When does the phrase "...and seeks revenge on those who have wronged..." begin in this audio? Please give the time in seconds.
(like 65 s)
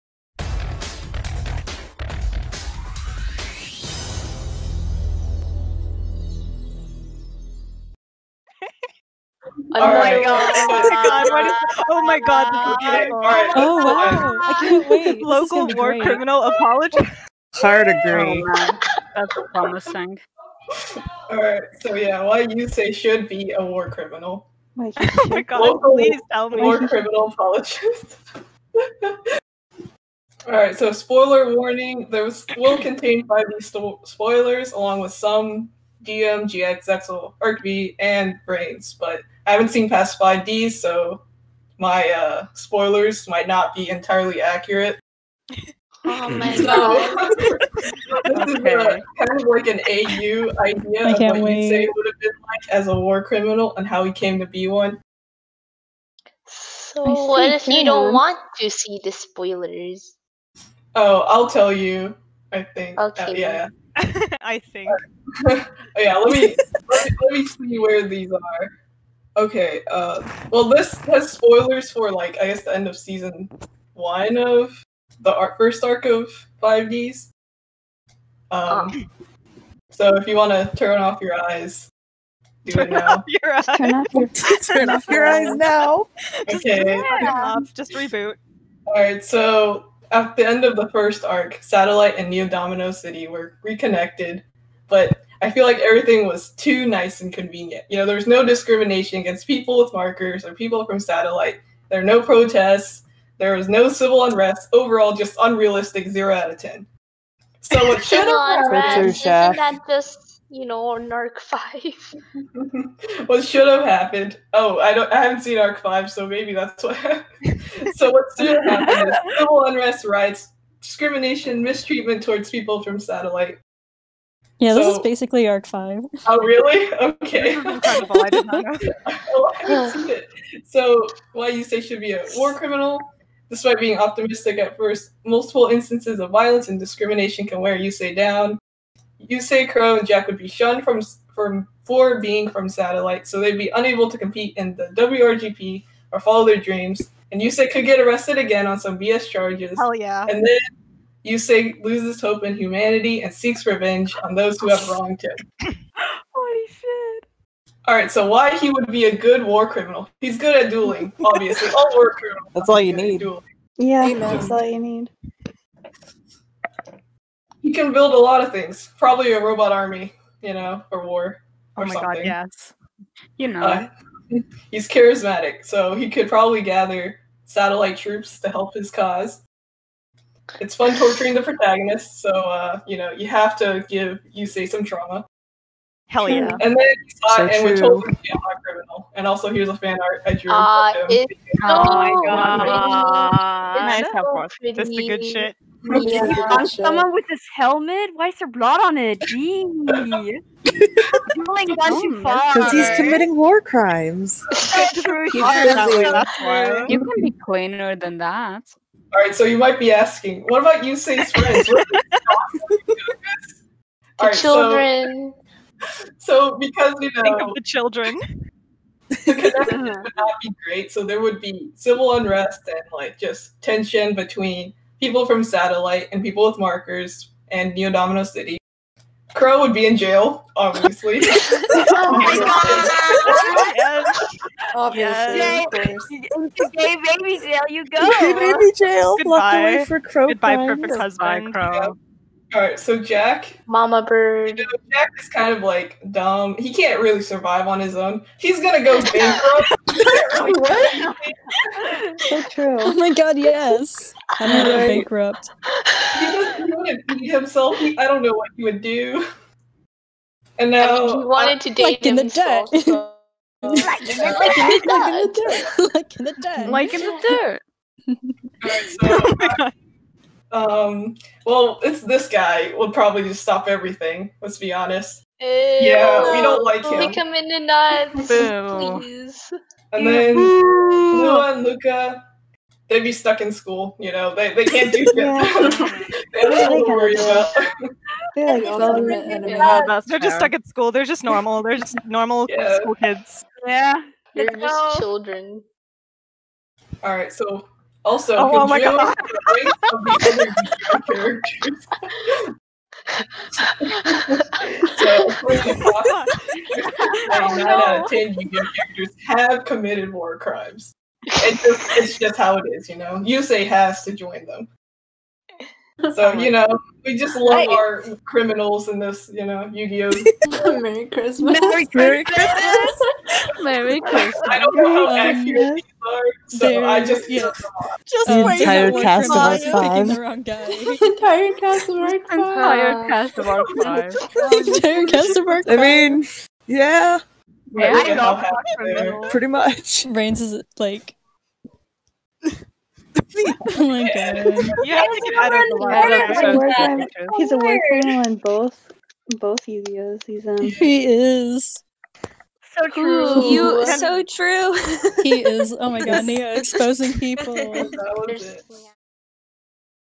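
153 s.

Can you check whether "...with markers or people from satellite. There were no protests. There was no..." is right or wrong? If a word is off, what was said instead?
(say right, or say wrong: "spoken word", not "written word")
right.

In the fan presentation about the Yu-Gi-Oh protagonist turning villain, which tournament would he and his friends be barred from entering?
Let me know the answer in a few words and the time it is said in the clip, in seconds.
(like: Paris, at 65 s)
WRGP, at 144 s.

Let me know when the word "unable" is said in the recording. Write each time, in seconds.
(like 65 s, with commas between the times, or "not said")
143 s.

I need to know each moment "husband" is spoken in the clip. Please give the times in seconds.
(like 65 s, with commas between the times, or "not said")
240 s.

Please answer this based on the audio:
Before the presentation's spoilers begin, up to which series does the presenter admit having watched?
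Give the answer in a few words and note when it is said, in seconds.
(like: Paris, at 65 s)
5D, at 40 s.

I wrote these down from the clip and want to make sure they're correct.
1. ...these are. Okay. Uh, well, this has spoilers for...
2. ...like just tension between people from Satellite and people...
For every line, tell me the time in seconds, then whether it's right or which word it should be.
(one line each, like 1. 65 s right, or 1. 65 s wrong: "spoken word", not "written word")
1. 68 s right
2. 222 s right.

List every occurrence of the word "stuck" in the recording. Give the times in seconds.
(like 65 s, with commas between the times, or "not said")
283 s, 290 s.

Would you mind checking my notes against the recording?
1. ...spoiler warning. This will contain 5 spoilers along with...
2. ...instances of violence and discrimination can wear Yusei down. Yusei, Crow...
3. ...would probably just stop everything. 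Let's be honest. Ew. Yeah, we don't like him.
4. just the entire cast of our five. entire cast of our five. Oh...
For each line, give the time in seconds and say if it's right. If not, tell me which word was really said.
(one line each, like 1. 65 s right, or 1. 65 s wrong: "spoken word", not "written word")
1. 30 s right
2. 135 s right
3. 272 s right
4. 328 s right.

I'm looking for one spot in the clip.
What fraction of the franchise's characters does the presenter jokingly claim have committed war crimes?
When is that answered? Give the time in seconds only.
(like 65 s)
307 s.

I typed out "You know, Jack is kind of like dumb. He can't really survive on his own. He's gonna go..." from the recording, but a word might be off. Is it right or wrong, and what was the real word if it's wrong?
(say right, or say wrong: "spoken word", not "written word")
right.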